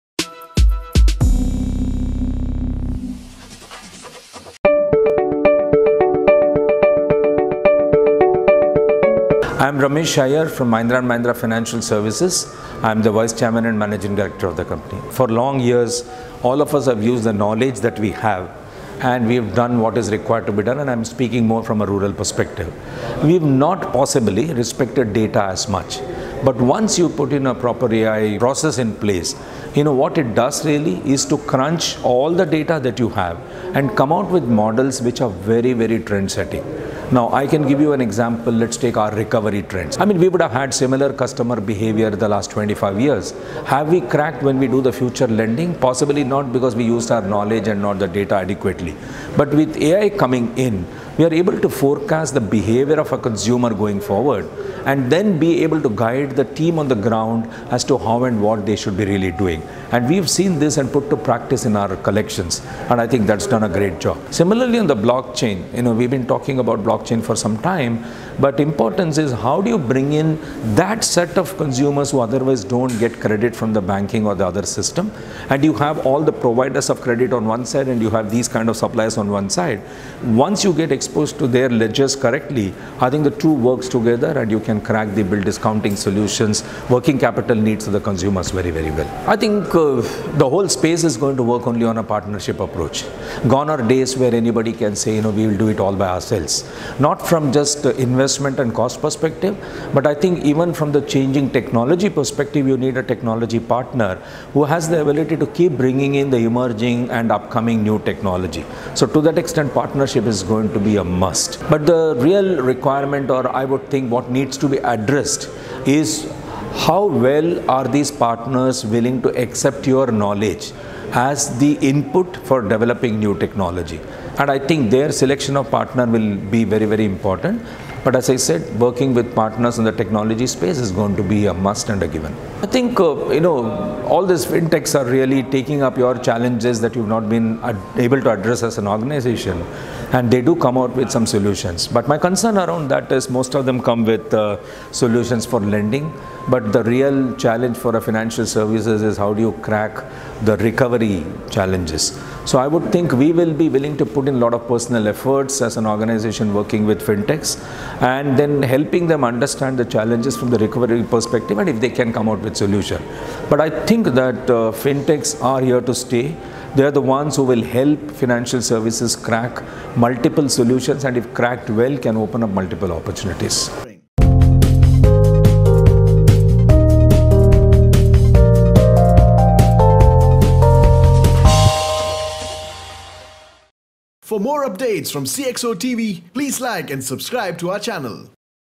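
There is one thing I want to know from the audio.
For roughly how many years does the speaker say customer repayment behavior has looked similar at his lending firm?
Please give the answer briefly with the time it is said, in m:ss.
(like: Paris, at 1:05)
25 years, at 0:42.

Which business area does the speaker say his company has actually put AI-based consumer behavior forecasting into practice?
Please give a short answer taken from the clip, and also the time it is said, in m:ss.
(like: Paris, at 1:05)
collections, at 1:01.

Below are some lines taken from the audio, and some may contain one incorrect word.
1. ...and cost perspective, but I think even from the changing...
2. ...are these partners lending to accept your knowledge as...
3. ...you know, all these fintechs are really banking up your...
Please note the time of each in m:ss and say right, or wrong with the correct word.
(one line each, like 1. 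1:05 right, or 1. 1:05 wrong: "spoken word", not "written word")
1. 1:38 right
2. 1:57 wrong: "willing", not "lending"
3. 2:13 wrong: "taking", not "banking".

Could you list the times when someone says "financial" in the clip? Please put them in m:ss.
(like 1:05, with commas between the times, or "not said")
0:11, 2:28, 2:48.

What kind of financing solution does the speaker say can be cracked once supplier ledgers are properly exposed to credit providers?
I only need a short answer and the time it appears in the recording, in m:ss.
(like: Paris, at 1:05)
bill discounting, at 1:25.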